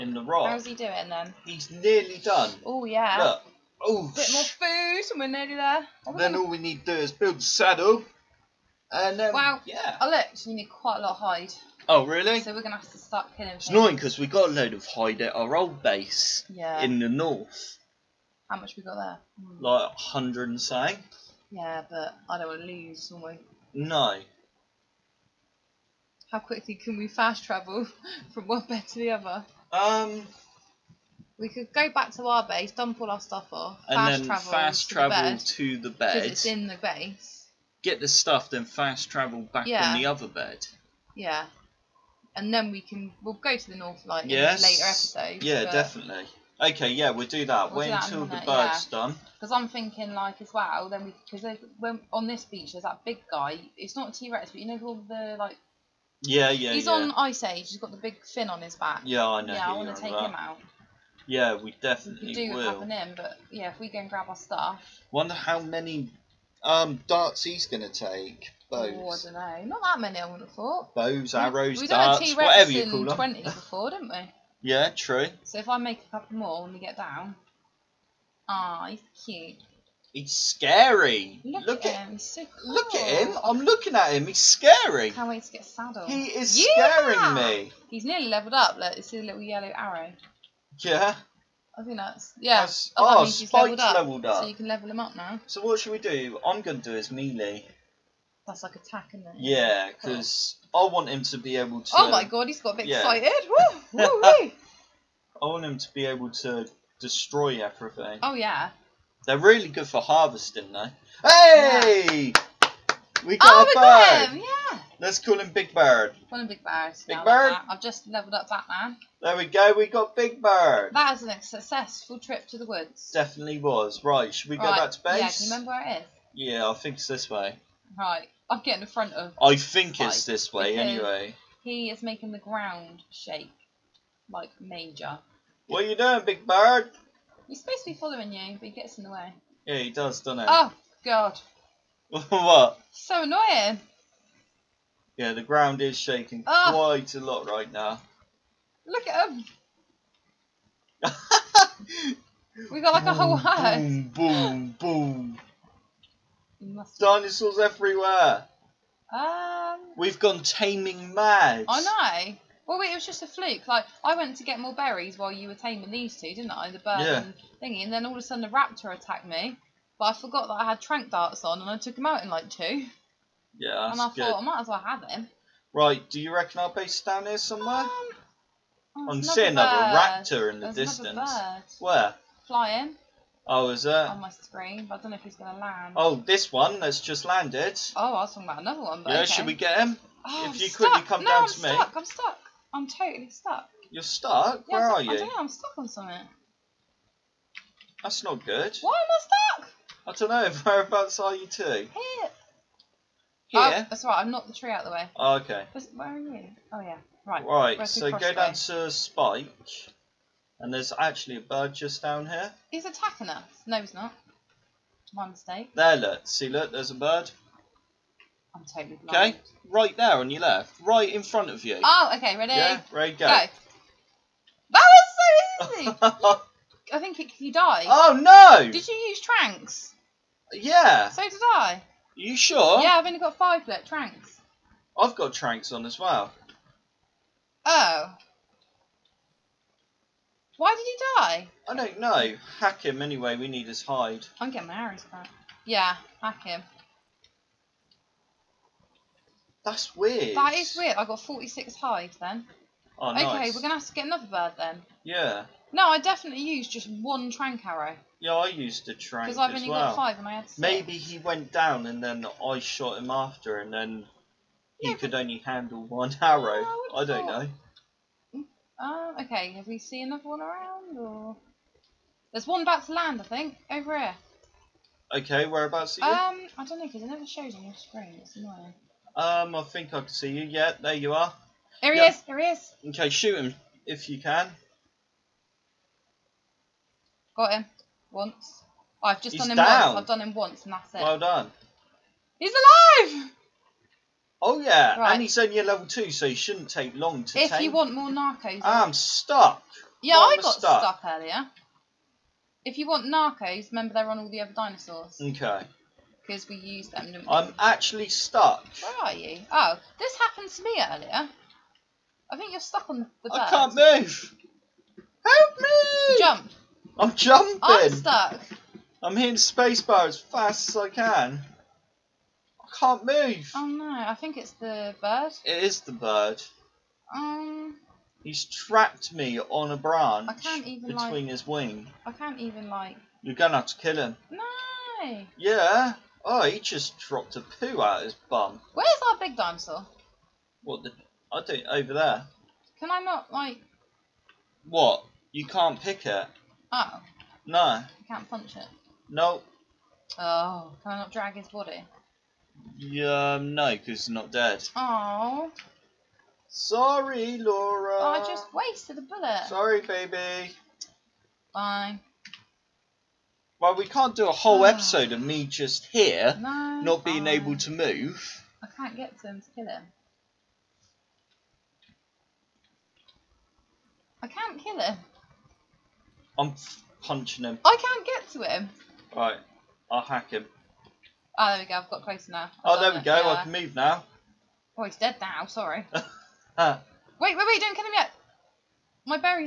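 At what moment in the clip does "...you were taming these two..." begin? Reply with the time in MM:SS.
02:45.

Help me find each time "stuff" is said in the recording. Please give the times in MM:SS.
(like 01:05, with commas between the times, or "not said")
00:33, 00:38, 01:04.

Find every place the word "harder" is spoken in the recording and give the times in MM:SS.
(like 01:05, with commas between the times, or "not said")
not said.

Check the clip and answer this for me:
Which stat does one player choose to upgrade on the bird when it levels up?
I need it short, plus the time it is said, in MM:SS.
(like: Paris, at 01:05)
melee, at 01:36.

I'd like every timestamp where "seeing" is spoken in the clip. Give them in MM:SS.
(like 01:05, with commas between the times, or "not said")
02:59.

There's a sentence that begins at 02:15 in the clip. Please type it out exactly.
What are you doing, Big Bird?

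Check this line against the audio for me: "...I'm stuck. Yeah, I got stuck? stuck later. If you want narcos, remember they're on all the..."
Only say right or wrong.
wrong.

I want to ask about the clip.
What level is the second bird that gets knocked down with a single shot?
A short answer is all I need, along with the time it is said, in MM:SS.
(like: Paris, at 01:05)
level 2, at 04:55.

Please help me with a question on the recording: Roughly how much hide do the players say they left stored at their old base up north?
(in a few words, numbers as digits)
a hundred and something.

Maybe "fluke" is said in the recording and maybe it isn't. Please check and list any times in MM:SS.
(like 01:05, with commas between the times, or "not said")
02:43.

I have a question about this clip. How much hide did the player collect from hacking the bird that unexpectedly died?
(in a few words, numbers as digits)
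46.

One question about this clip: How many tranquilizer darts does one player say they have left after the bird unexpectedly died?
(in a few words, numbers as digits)
5.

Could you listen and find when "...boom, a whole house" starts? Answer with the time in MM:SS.
02:33.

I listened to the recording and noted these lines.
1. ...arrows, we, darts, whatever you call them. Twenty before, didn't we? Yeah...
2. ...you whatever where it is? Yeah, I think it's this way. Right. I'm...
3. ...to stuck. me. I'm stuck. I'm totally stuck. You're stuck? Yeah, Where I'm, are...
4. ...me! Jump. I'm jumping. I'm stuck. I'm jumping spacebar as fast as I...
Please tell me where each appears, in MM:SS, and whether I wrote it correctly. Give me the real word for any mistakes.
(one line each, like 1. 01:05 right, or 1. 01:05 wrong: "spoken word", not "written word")
1. 01:11 right
2. 02:05 wrong: "remember", not "whatever"
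3. 03:11 right
4. 05:15 wrong: "hitting", not "jumping".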